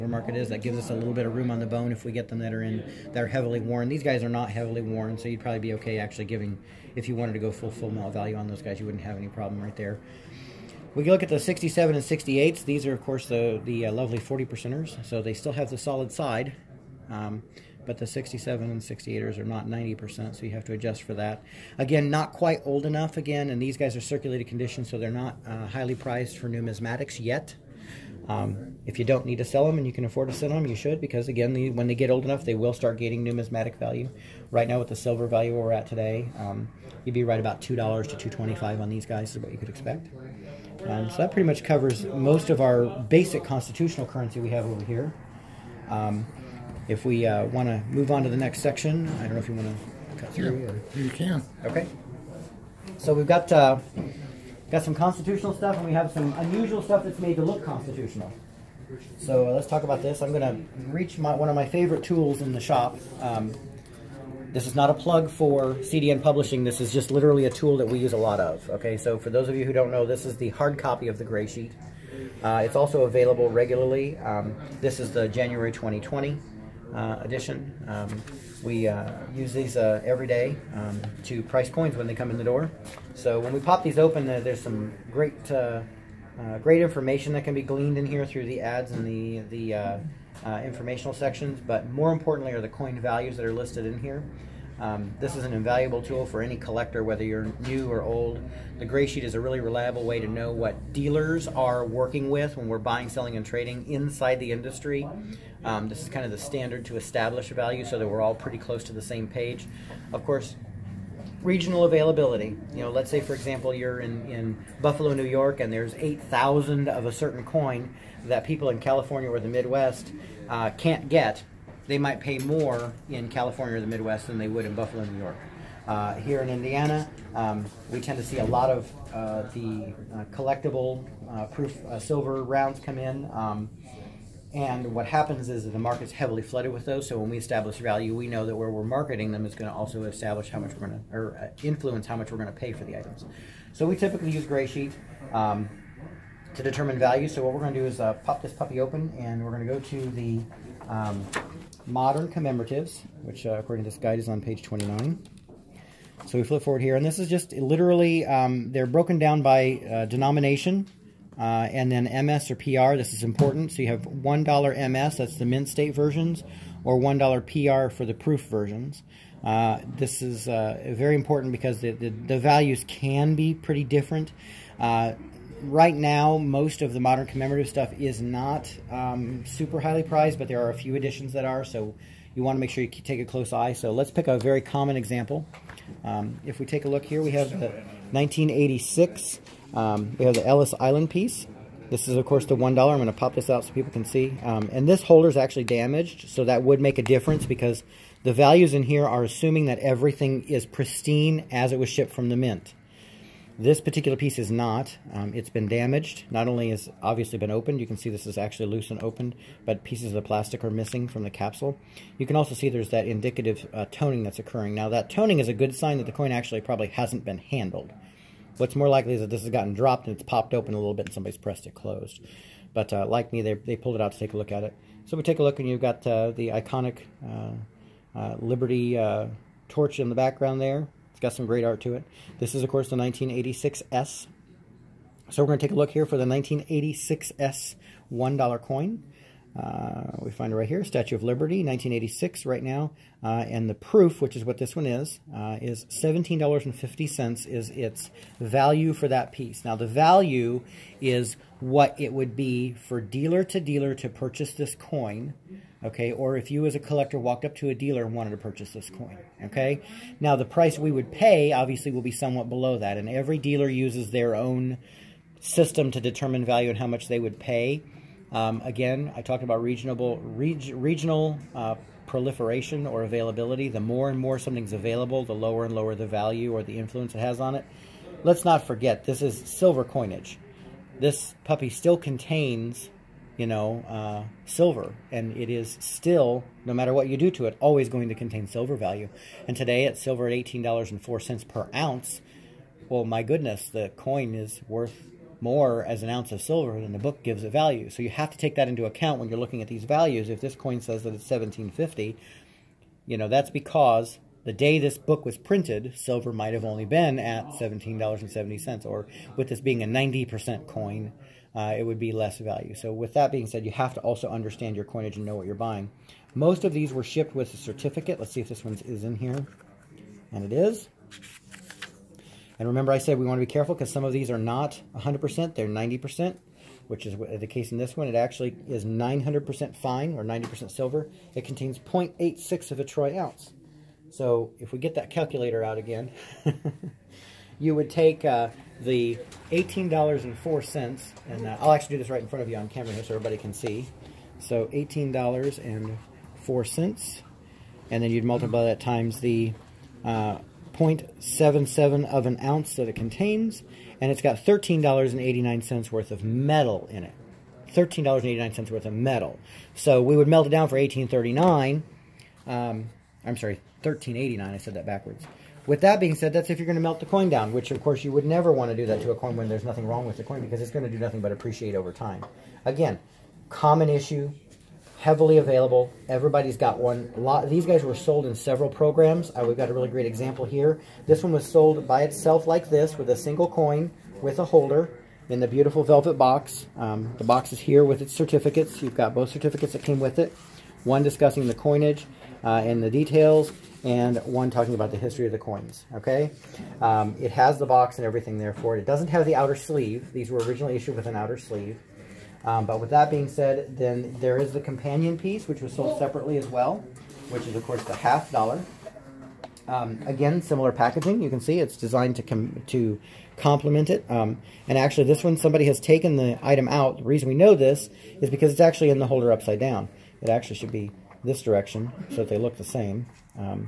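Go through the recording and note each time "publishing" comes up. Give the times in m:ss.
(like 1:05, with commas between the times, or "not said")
1:06.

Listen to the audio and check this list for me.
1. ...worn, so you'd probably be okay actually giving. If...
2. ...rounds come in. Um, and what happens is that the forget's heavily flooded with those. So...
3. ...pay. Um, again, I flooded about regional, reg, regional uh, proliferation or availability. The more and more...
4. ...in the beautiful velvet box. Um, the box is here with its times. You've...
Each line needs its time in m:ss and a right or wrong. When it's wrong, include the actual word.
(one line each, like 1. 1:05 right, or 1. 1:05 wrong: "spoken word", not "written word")
1. 0:04 right
2. 2:12 wrong: "market", not "forget"
3. 4:27 wrong: "talked", not "flooded"
4. 6:25 wrong: "certificates", not "times".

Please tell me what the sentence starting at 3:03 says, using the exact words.
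So let's pick a very common example.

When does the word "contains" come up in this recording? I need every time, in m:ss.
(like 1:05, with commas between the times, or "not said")
4:41, 4:48, 5:31, 5:52.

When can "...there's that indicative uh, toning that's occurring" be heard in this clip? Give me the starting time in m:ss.
3:32.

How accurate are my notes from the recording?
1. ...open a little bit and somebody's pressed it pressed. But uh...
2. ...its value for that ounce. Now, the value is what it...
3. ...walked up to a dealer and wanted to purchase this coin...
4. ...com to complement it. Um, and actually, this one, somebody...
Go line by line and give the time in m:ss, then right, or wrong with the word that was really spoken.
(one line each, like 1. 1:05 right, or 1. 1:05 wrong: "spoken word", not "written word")
1. 3:40 wrong: "closed", not "pressed"
2. 4:07 wrong: "piece", not "ounce"
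3. 4:17 right
4. 6:52 right.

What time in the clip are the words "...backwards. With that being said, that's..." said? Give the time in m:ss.
6:04.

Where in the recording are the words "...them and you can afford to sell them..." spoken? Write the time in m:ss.
0:29.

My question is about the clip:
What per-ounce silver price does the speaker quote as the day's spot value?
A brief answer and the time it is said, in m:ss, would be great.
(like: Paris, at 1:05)
$18.04, at 4:50.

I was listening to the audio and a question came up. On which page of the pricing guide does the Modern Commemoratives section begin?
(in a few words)
29.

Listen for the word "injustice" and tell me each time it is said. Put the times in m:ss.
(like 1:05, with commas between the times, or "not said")
not said.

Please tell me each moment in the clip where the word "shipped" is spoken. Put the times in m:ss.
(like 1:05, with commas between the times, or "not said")
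3:21, 5:17.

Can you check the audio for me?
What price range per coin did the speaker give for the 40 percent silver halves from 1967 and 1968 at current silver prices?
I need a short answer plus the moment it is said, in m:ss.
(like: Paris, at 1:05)
$2 to $2.25, at 0:37.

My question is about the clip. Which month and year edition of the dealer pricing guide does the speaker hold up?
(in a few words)
January 2020.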